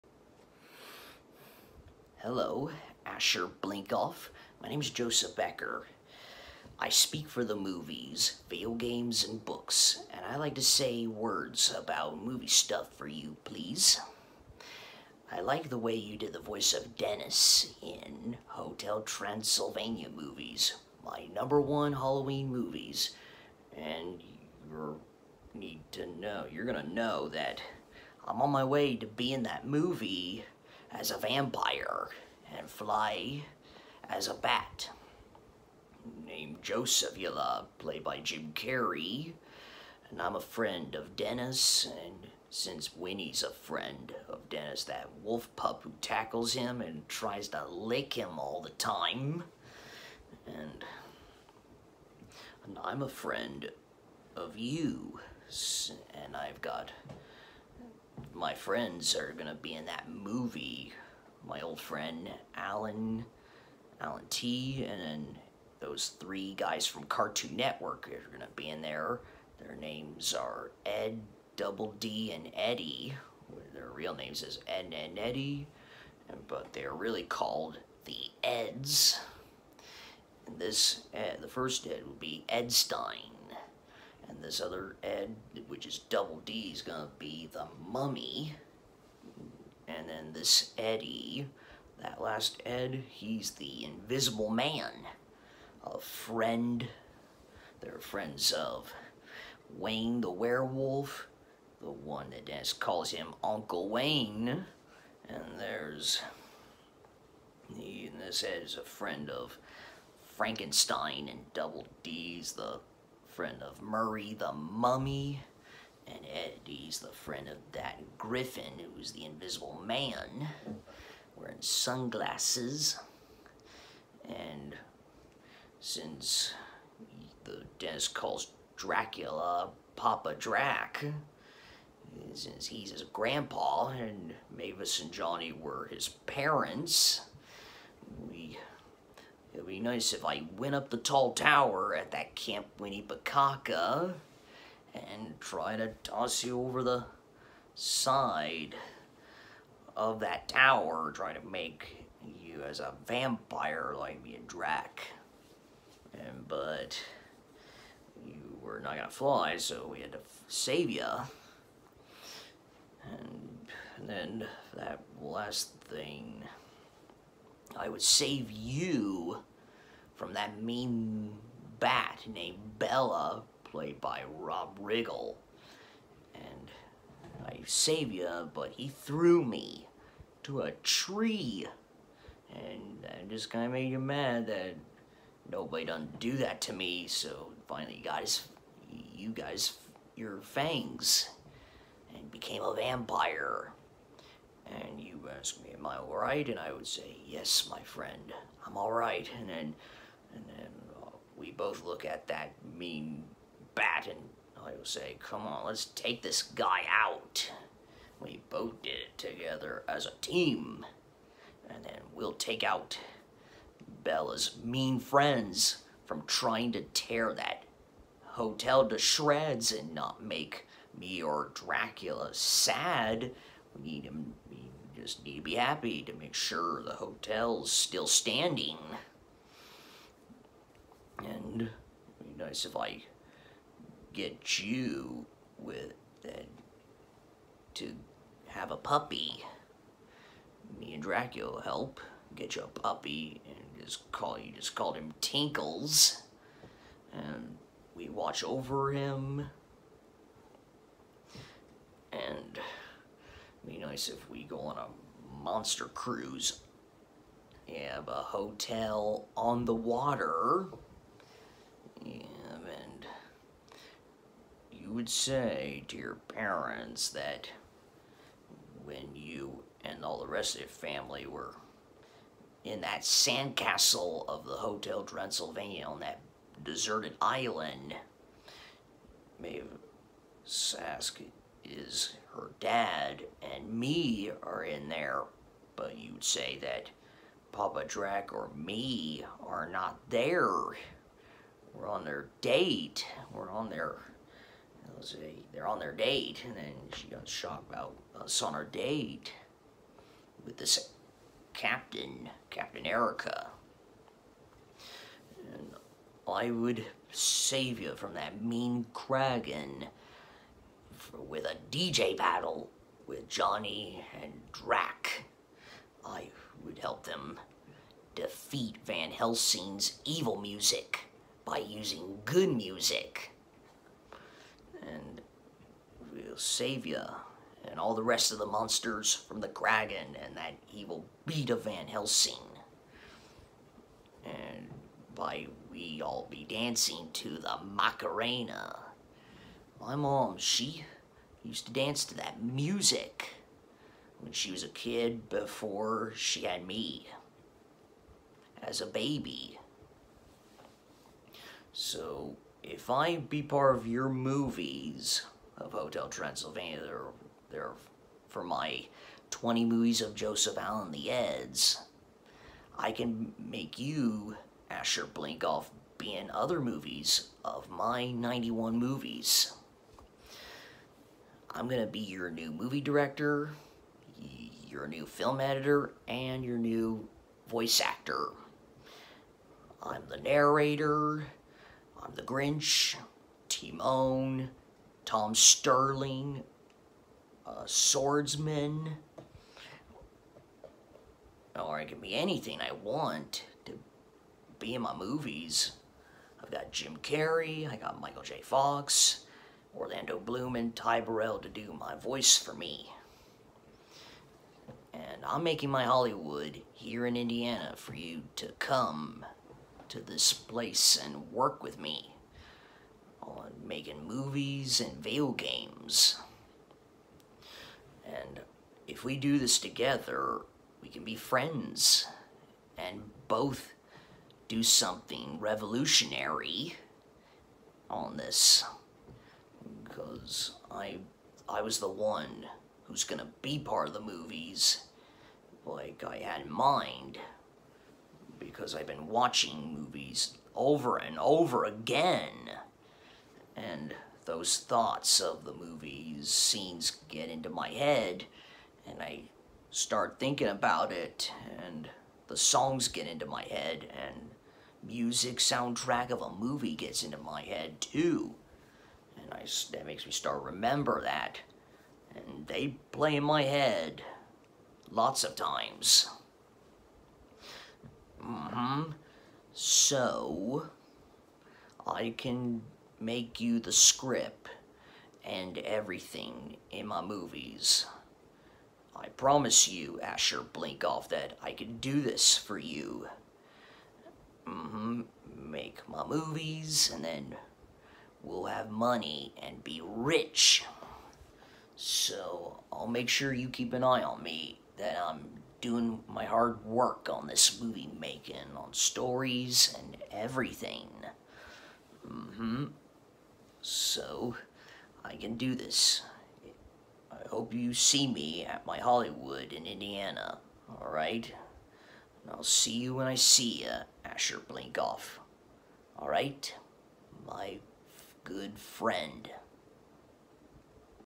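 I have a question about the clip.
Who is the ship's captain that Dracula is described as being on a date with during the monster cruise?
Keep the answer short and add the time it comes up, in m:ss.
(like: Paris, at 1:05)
Captain Erica, at 5:02.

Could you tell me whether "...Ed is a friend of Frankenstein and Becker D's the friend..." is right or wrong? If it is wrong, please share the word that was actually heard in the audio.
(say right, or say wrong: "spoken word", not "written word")
wrong: "Double", not "Becker".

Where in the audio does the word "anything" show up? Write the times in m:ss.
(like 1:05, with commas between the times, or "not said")
6:32.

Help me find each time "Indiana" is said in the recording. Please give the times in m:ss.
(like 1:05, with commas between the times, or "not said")
6:47, 8:29.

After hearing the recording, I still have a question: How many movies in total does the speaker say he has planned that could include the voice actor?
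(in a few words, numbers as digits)
91.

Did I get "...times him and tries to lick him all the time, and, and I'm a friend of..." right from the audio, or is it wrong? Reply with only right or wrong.
wrong.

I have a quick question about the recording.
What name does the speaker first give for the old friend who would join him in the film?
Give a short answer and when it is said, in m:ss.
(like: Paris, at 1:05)
Alan, at 1:01.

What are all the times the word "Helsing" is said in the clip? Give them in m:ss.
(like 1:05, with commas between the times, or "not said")
5:19, 5:31.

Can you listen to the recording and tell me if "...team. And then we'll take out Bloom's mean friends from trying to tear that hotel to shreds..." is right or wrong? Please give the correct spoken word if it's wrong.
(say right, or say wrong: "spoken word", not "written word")
wrong: "Bela", not "Bloom".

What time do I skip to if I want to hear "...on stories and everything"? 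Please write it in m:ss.
8:18.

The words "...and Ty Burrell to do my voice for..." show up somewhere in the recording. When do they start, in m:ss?
6:40.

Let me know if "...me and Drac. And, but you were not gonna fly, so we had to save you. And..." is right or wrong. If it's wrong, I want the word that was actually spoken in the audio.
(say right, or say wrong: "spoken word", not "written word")
right.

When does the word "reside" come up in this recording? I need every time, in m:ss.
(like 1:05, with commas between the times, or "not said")
not said.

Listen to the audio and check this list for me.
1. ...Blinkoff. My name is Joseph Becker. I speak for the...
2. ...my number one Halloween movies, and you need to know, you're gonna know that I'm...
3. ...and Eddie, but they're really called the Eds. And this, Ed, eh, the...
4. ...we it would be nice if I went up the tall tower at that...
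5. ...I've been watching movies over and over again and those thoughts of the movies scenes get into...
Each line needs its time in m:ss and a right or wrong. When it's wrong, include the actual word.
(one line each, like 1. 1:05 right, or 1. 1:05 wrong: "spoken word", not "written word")
1. 0:03 right
2. 0:21 right
3. 1:14 right
4. 2:18 right
5. 7:18 right.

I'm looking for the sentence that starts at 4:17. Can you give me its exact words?
Have a hotel on the water.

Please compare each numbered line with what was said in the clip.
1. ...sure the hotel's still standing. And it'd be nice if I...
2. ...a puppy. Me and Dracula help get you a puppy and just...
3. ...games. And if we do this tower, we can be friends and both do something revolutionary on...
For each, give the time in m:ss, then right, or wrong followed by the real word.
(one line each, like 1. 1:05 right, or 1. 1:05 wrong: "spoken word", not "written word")
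1. 3:46 right
2. 3:58 right
3. 6:55 wrong: "together", not "tower".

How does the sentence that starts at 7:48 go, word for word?
Mm hmm So, I can make you the script and everything in my movies.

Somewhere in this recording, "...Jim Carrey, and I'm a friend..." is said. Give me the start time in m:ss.
0:38.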